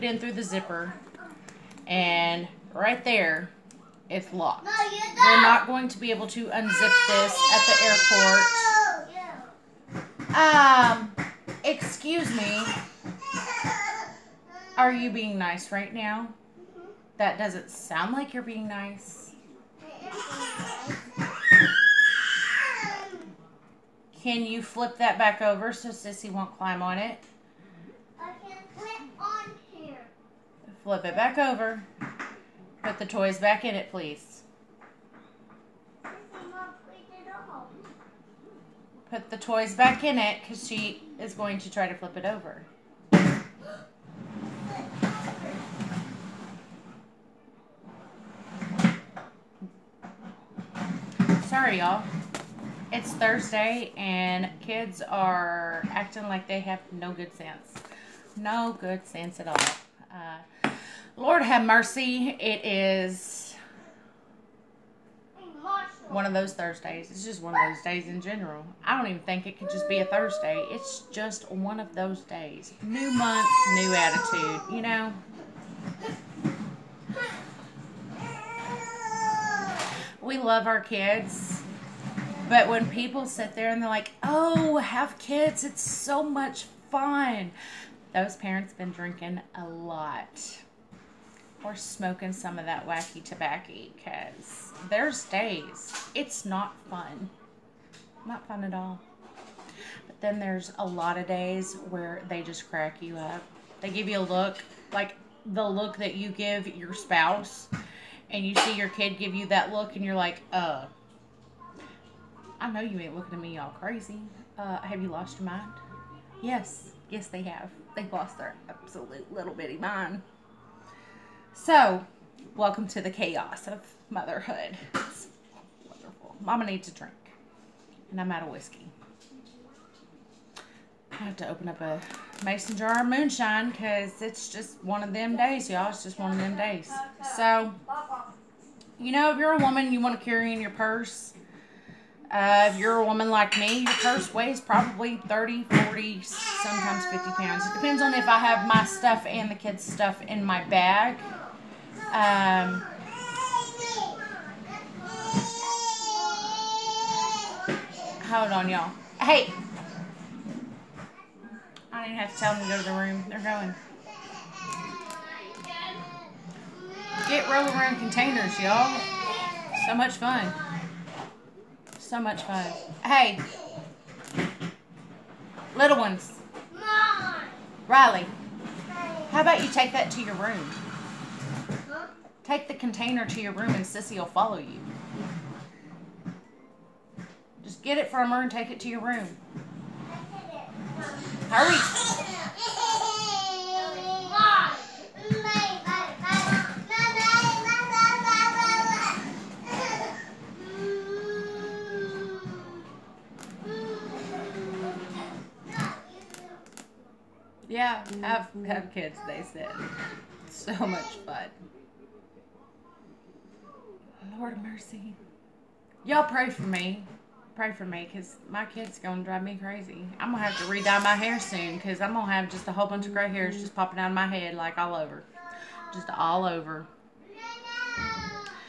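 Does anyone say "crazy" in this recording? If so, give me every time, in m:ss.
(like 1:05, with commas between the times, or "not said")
1:53, 3:39.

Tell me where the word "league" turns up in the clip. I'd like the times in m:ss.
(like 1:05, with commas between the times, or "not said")
not said.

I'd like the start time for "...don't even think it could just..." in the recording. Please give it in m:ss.
1:08.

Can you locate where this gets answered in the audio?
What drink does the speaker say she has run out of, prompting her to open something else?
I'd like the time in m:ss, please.
2:08.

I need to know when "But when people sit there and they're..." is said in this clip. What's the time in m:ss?
1:22.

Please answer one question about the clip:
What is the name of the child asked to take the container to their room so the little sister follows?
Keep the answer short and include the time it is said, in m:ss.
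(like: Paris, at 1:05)
Riley, at 2:57.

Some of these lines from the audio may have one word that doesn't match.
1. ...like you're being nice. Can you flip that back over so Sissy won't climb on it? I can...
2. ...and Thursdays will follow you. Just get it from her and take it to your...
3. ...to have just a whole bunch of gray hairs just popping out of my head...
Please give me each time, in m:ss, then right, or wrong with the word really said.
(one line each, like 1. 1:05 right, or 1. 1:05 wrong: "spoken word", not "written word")
1. 0:18 right
2. 3:03 wrong: "Sissy", not "Thursdays"
3. 3:42 right.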